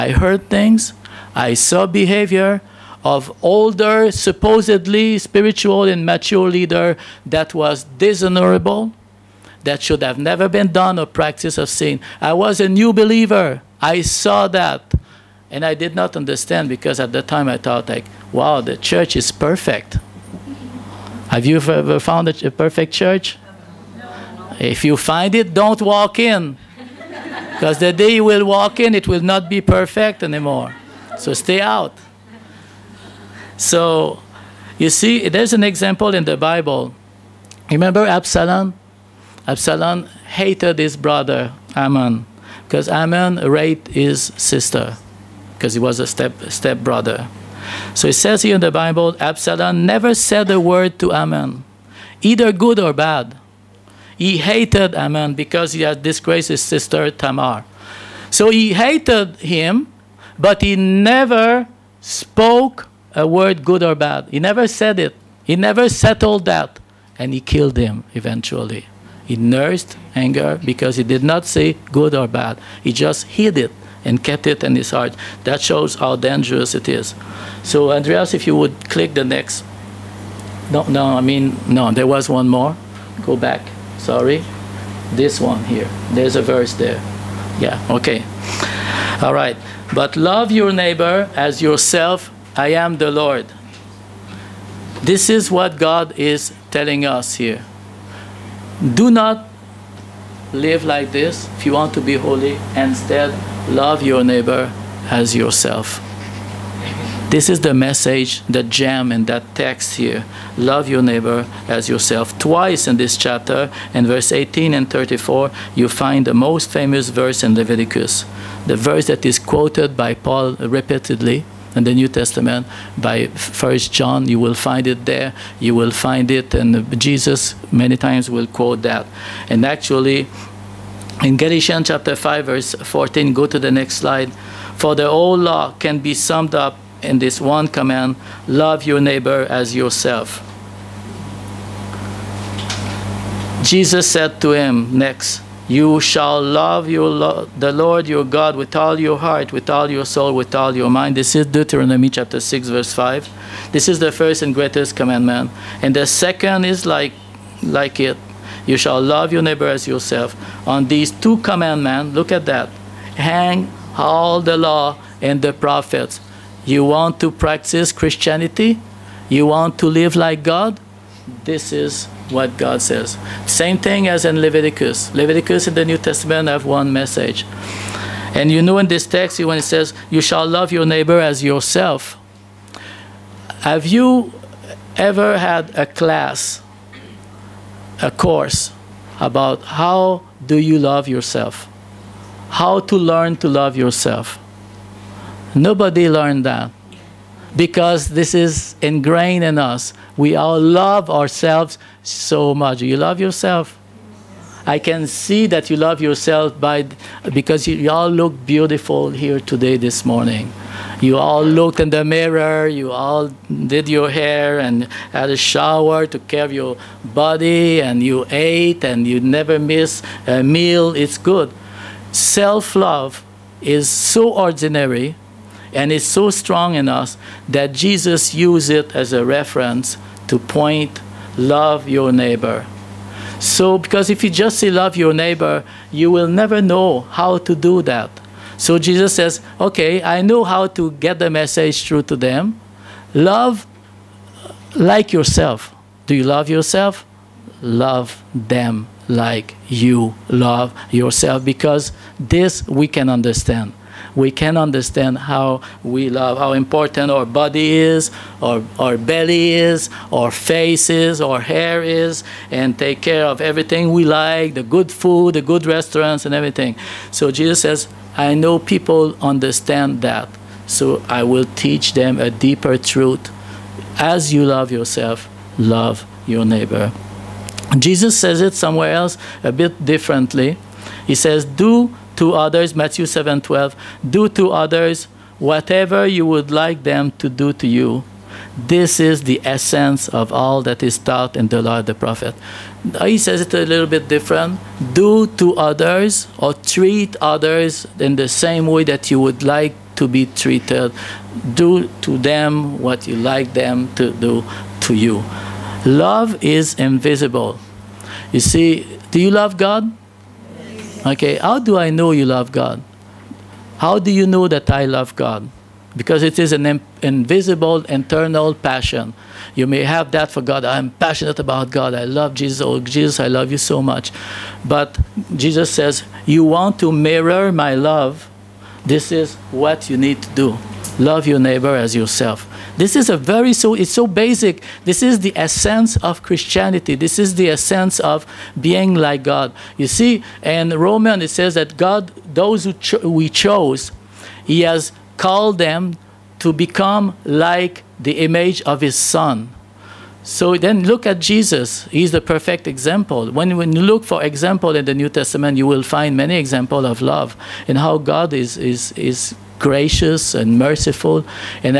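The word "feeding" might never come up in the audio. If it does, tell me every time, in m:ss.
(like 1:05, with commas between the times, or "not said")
not said.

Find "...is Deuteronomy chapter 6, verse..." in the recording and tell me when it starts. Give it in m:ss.
2:31.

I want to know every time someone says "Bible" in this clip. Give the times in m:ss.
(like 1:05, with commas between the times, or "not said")
0:36, 0:48.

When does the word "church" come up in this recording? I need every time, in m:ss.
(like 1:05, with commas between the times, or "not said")
0:18, 0:22.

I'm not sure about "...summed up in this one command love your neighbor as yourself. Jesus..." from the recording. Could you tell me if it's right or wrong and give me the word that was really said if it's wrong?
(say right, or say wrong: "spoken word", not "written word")
right.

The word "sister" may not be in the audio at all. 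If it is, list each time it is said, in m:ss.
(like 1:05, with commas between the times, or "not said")
0:44, 0:56.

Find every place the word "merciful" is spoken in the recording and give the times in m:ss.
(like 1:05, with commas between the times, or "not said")
6:00.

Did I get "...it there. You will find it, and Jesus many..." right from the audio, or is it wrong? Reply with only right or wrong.
right.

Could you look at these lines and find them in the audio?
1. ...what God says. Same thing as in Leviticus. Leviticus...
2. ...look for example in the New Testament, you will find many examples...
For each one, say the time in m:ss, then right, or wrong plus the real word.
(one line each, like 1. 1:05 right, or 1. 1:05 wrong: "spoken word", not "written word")
1. 2:52 right
2. 5:53 right.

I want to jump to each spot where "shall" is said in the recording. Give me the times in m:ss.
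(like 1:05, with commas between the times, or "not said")
2:26, 2:38, 3:00.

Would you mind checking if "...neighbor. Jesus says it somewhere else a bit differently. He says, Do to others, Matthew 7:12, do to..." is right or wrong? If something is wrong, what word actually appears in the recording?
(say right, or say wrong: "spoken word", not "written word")
right.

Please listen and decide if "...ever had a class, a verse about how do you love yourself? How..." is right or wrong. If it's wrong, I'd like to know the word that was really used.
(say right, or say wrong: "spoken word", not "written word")
wrong: "course", not "verse".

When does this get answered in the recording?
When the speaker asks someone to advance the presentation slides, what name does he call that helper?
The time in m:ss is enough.
1:17.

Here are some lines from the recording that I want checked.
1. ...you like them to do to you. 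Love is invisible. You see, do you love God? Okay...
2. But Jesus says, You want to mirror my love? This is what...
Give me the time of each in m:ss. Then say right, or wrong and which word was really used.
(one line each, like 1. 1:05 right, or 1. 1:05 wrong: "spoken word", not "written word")
1. 5:03 right
2. 5:24 right.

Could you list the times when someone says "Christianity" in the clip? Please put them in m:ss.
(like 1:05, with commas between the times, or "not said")
2:47, 5:36.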